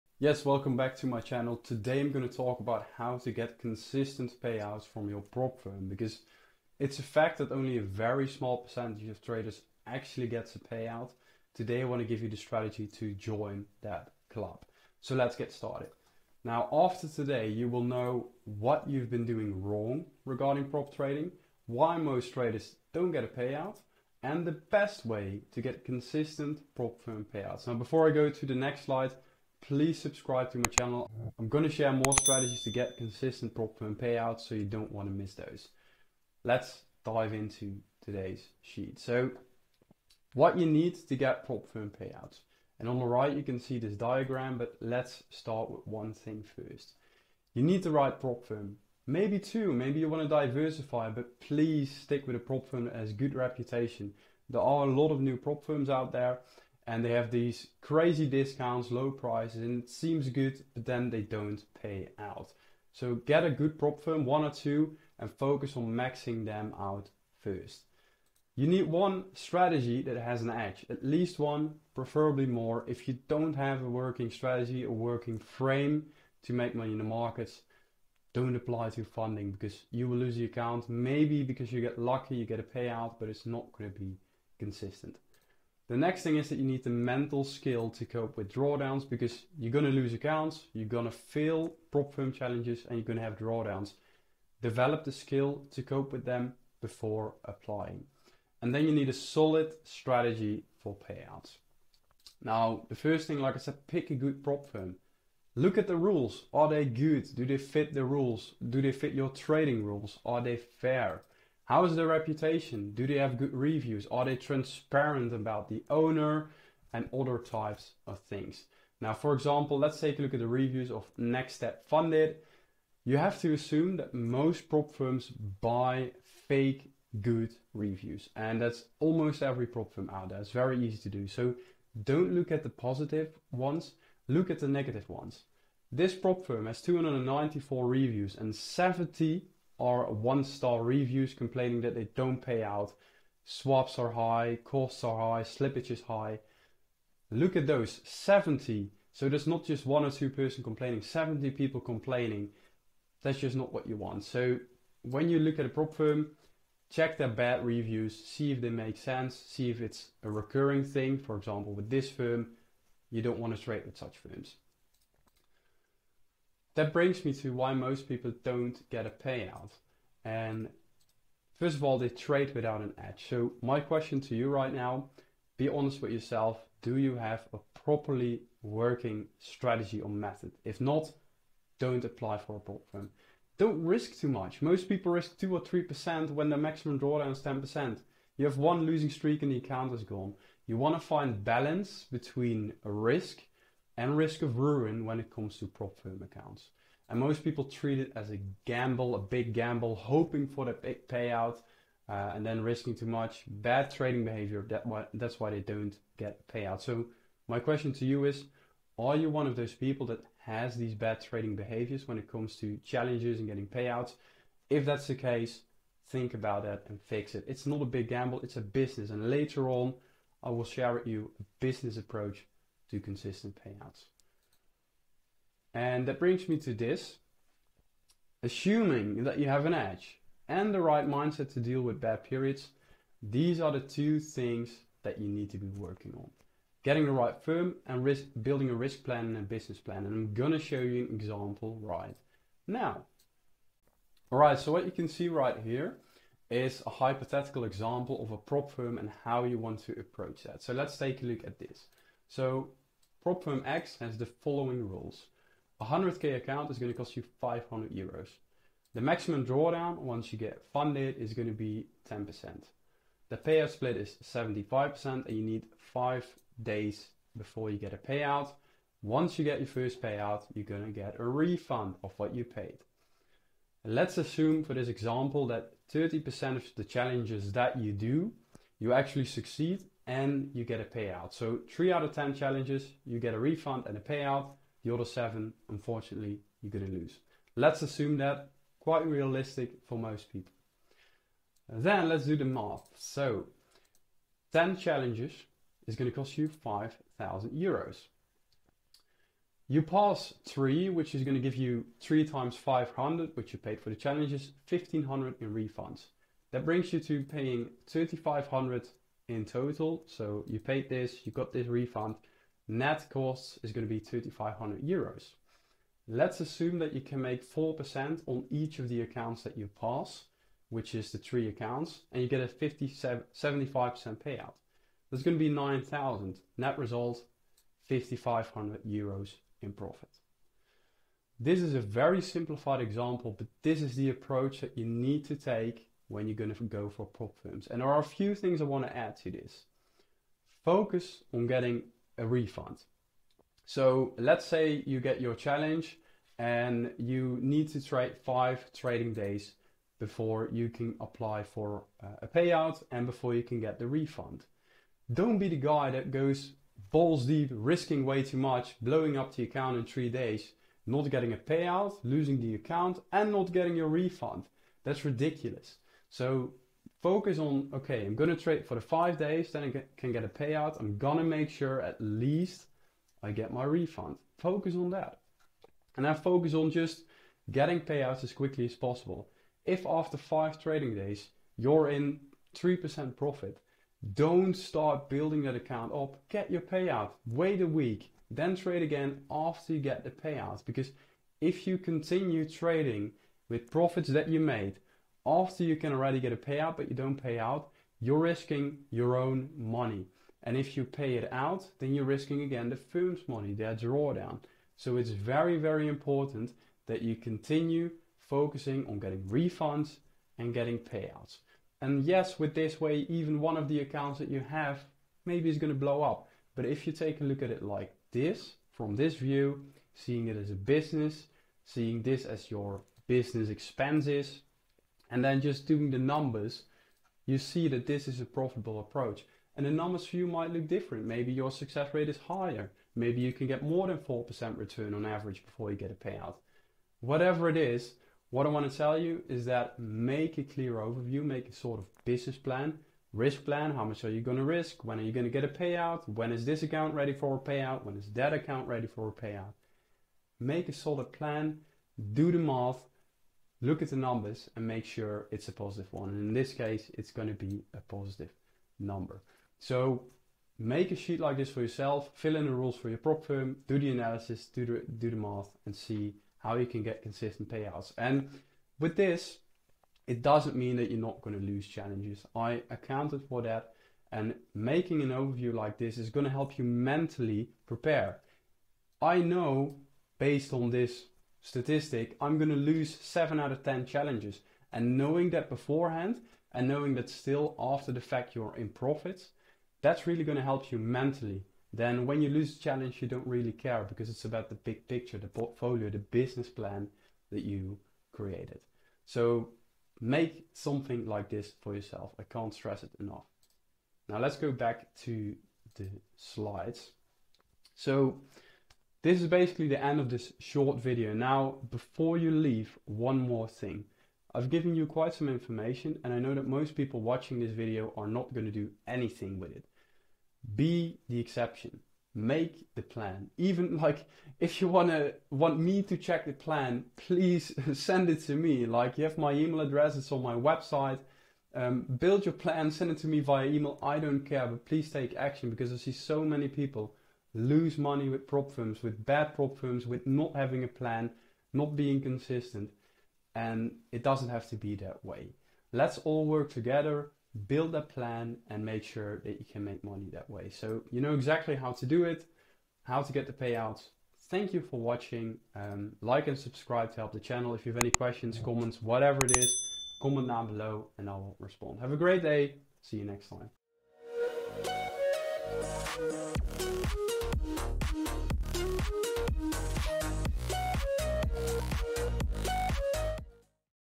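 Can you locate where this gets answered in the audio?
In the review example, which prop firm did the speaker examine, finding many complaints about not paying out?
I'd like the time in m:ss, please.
2:01.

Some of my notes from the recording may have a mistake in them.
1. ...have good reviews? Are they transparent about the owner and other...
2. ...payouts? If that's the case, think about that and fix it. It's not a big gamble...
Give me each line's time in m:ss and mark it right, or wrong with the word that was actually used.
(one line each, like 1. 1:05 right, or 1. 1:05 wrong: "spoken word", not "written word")
1. 1:53 right
2. 3:33 right.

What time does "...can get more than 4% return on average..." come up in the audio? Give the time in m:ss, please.
7:13.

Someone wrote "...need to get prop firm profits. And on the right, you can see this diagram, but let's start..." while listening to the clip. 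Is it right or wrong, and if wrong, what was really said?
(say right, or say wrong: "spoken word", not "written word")
wrong: "payouts", not "profits".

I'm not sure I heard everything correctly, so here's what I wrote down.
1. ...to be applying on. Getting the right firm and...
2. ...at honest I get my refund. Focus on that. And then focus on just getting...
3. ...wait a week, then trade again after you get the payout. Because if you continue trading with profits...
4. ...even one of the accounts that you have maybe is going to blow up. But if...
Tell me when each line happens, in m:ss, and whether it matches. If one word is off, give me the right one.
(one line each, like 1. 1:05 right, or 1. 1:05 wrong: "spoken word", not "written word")
1. 3:55 wrong: "working", not "applying"
2. 6:11 wrong: "least", not "honest"
3. 6:27 right
4. 6:53 right.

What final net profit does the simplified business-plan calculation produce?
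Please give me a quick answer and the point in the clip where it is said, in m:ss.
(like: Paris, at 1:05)
5,500 euros, at 5:27.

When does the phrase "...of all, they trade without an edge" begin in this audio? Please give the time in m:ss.
2:51.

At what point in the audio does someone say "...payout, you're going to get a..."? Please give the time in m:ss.
4:30.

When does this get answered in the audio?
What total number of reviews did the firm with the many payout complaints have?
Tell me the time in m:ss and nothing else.
2:16.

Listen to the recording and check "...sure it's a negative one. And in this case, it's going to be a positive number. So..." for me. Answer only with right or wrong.
wrong.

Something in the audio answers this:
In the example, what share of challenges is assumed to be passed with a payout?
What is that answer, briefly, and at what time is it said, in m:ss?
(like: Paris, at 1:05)
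30%, at 4:35.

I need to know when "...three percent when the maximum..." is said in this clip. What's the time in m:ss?
3:05.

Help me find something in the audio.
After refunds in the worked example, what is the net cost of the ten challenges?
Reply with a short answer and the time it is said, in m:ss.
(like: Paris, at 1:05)
2,500 euros, at 5:13.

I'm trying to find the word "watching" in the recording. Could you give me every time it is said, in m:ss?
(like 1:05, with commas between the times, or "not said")
8:37, 9:14.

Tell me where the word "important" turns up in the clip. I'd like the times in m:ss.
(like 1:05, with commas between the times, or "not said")
6:45.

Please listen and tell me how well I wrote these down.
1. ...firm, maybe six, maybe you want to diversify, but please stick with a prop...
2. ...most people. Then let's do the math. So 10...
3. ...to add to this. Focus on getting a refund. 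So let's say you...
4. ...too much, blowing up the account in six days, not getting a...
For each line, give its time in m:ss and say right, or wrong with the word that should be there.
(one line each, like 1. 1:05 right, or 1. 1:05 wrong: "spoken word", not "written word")
1. 0:48 wrong: "two", not "six"
2. 4:49 right
3. 5:38 right
4. 5:58 wrong: "three", not "six".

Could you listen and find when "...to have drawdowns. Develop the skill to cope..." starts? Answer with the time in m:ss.
1:33.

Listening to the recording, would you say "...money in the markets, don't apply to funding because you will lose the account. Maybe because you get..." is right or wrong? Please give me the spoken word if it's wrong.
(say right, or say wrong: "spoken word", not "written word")
right.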